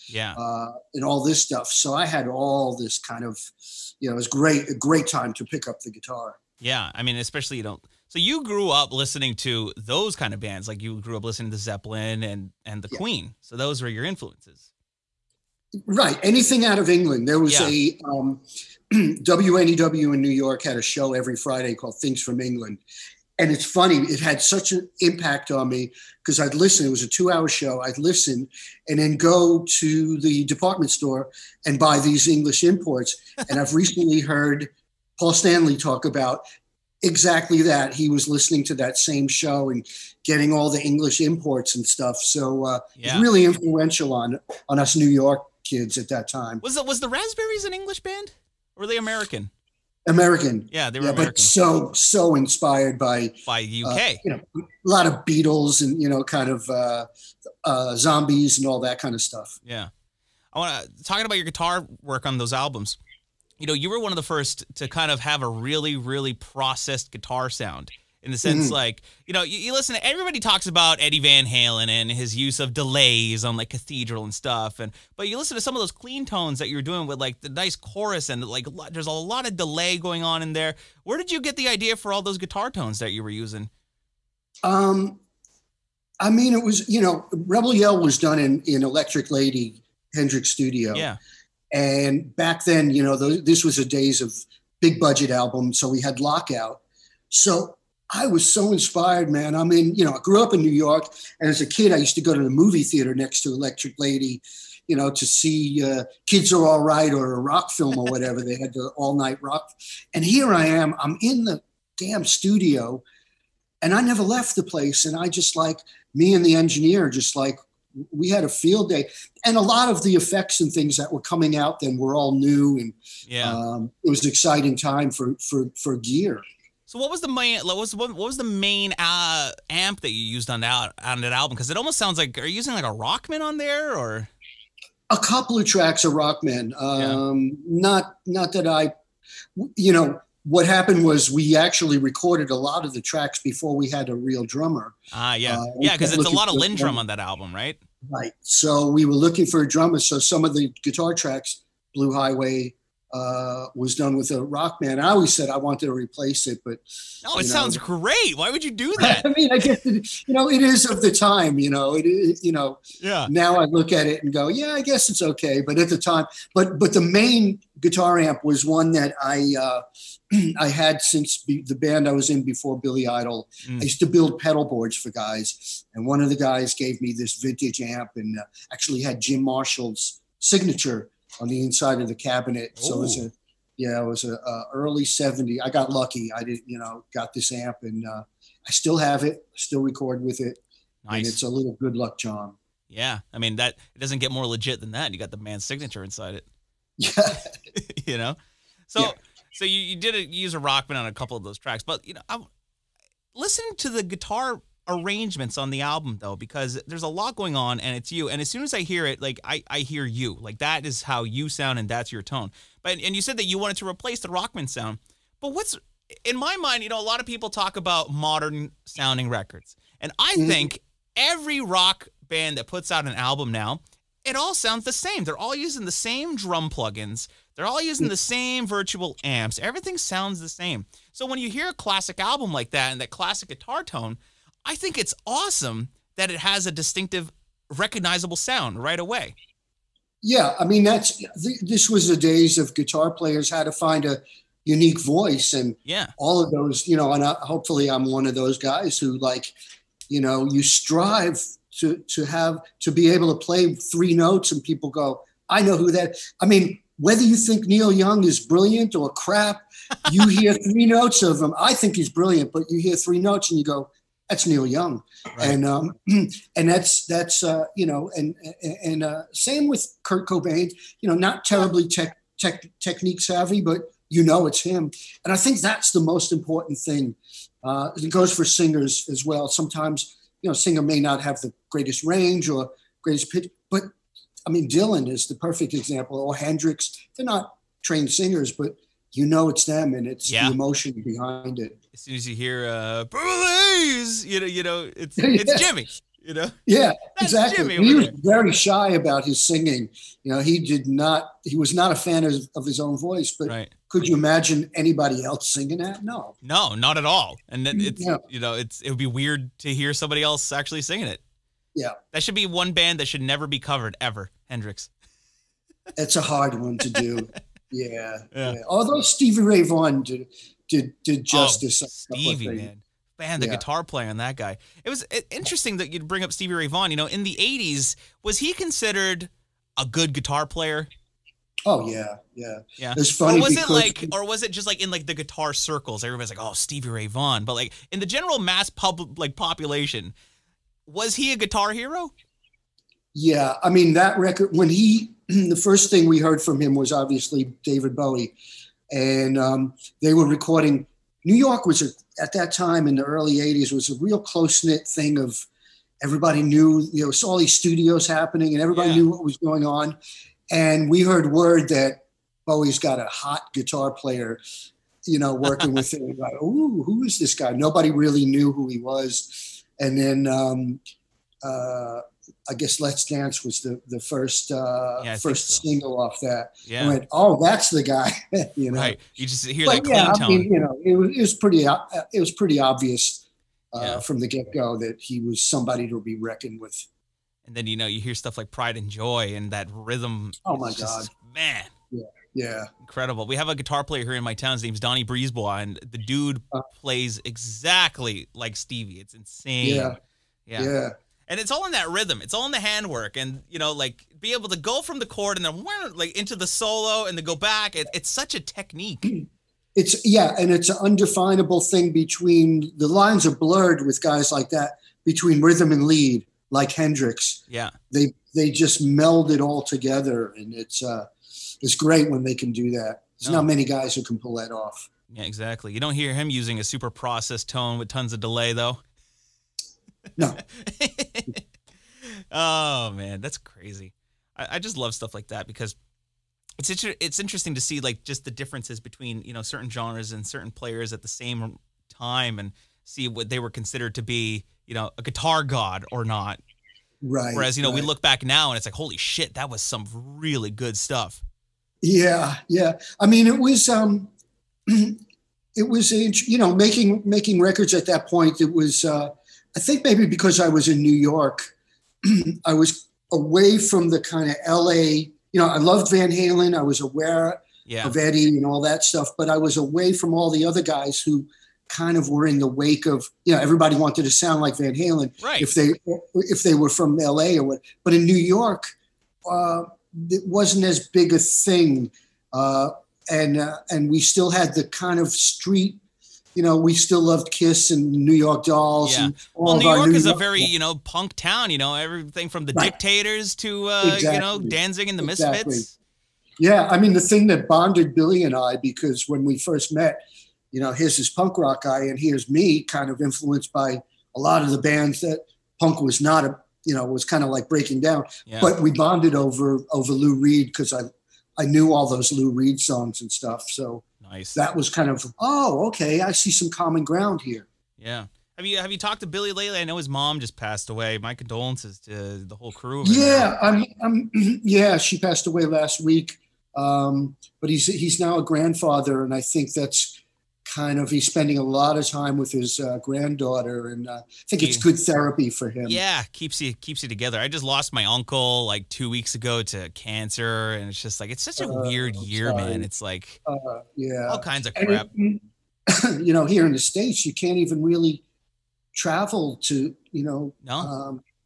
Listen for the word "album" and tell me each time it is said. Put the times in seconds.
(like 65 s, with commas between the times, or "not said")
62 s, 95 s, 131 s, 147 s, 205 s, 223 s, 232 s.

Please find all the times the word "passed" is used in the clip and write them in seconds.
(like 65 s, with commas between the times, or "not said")
520 s, 524 s.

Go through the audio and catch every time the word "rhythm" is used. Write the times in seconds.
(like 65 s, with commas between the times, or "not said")
389 s, 401 s, 415 s.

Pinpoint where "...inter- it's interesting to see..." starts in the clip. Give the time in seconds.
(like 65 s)
436 s.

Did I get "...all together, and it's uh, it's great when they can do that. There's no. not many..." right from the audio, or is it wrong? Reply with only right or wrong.
right.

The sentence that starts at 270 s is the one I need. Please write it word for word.
You know, not terribly tech, tech, technique savvy, but you know it's him.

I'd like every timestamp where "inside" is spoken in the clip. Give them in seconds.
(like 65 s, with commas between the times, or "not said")
181 s, 196 s.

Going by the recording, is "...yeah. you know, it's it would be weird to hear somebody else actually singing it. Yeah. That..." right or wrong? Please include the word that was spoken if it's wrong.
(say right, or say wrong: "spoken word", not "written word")
right.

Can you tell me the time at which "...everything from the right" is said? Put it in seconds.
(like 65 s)
491 s.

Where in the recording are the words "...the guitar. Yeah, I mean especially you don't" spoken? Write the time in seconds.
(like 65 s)
5 s.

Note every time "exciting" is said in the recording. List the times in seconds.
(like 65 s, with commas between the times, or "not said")
124 s.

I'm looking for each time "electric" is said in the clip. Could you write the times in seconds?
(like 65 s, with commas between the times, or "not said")
88 s, 103 s.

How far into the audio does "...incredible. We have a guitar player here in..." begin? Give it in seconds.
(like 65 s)
392 s.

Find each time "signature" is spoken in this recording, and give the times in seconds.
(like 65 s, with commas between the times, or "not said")
180 s, 195 s.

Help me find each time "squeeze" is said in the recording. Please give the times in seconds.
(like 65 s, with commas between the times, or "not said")
not said.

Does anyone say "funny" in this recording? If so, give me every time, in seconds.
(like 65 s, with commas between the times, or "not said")
23 s, 333 s.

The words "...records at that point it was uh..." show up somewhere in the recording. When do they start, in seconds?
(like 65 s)
457 s.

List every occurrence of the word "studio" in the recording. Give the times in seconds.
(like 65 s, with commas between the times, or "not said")
90 s, 112 s, 357 s.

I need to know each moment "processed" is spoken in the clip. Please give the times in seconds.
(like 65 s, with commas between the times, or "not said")
66 s, 426 s.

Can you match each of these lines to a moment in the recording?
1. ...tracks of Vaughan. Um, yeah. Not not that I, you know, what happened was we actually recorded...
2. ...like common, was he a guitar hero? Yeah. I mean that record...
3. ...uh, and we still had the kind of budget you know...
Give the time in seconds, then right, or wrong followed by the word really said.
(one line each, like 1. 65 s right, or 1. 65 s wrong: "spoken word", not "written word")
1. 135 s wrong: "Rockman", not "Vaughan"
2. 339 s wrong: "population", not "common"
3. 483 s wrong: "street", not "budget".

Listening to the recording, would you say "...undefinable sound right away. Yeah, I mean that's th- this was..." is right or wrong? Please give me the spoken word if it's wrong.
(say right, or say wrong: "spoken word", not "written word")
wrong: "recognizable", not "undefinable".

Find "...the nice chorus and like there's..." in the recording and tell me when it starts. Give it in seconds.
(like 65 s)
77 s.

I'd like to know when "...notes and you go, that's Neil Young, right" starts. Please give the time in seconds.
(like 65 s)
263 s.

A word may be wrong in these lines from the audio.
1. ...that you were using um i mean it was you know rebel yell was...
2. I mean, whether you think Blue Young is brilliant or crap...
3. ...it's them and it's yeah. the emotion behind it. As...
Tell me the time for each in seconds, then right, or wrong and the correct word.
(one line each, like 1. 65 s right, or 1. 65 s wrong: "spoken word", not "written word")
1. 82 s right
2. 256 s wrong: "Neil", not "Blue"
3. 289 s right.